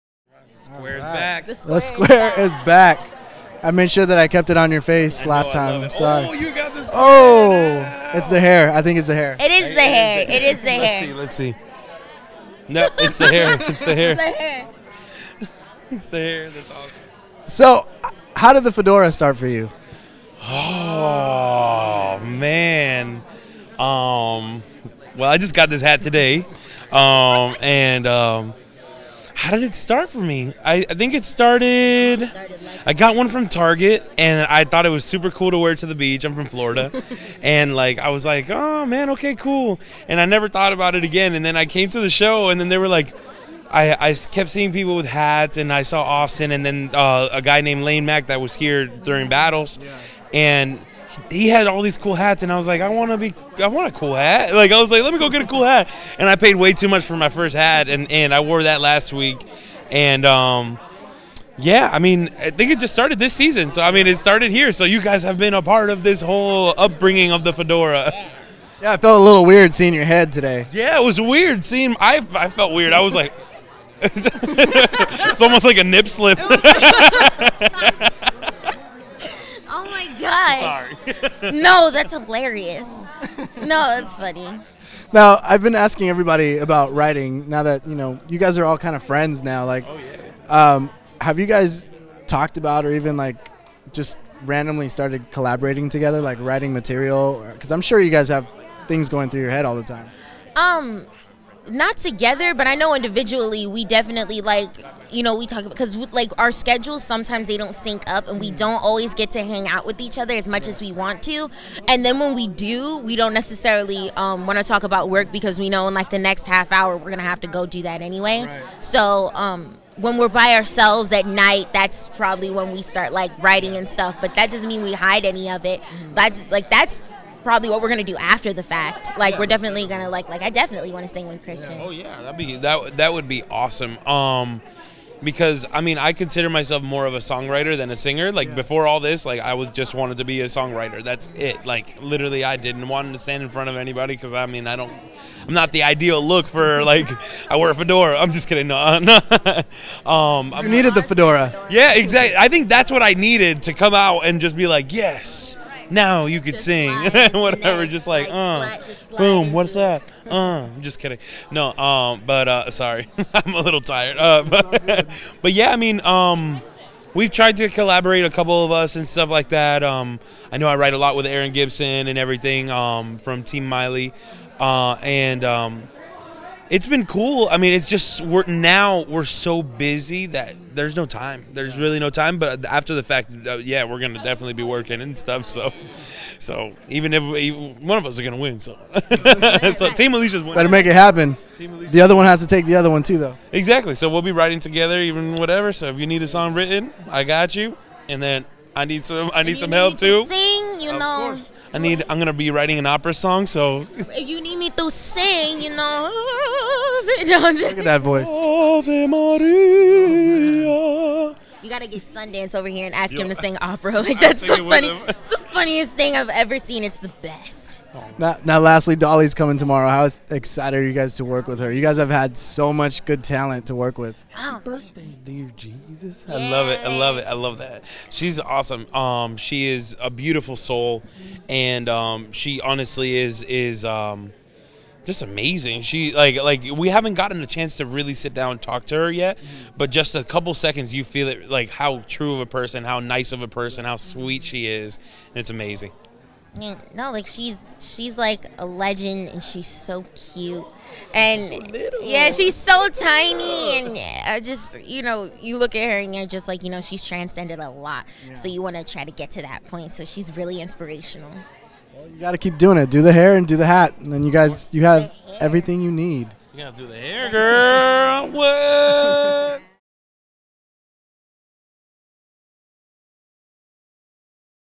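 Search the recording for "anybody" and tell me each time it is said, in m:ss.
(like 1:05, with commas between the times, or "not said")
2:23.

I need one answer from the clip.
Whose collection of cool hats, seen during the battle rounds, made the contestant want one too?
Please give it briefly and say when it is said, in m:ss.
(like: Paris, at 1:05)
Lane Mack, at 0:47.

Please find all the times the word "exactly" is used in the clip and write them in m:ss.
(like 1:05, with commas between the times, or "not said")
2:31, 3:13.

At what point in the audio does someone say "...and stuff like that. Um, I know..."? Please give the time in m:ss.
2:48.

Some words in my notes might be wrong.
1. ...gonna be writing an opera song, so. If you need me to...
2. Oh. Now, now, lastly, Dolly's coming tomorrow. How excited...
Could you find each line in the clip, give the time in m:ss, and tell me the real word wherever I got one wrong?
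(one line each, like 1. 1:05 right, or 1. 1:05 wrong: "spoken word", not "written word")
1. 3:22 right
2. 3:37 right.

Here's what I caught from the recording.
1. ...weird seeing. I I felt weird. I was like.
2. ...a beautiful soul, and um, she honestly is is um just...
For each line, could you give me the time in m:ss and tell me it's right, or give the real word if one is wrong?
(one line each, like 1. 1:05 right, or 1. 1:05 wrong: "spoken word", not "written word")
1. 1:11 right
2. 3:50 right.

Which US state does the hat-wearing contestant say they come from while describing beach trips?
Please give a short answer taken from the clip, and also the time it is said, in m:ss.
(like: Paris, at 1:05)
Florida, at 0:36.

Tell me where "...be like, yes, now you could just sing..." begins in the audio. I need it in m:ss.
2:34.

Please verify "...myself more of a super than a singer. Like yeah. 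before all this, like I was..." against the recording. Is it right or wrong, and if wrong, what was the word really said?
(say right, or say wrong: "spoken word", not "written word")
wrong: "songwriter", not "super".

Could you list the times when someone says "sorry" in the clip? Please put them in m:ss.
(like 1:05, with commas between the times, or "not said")
0:05, 2:42.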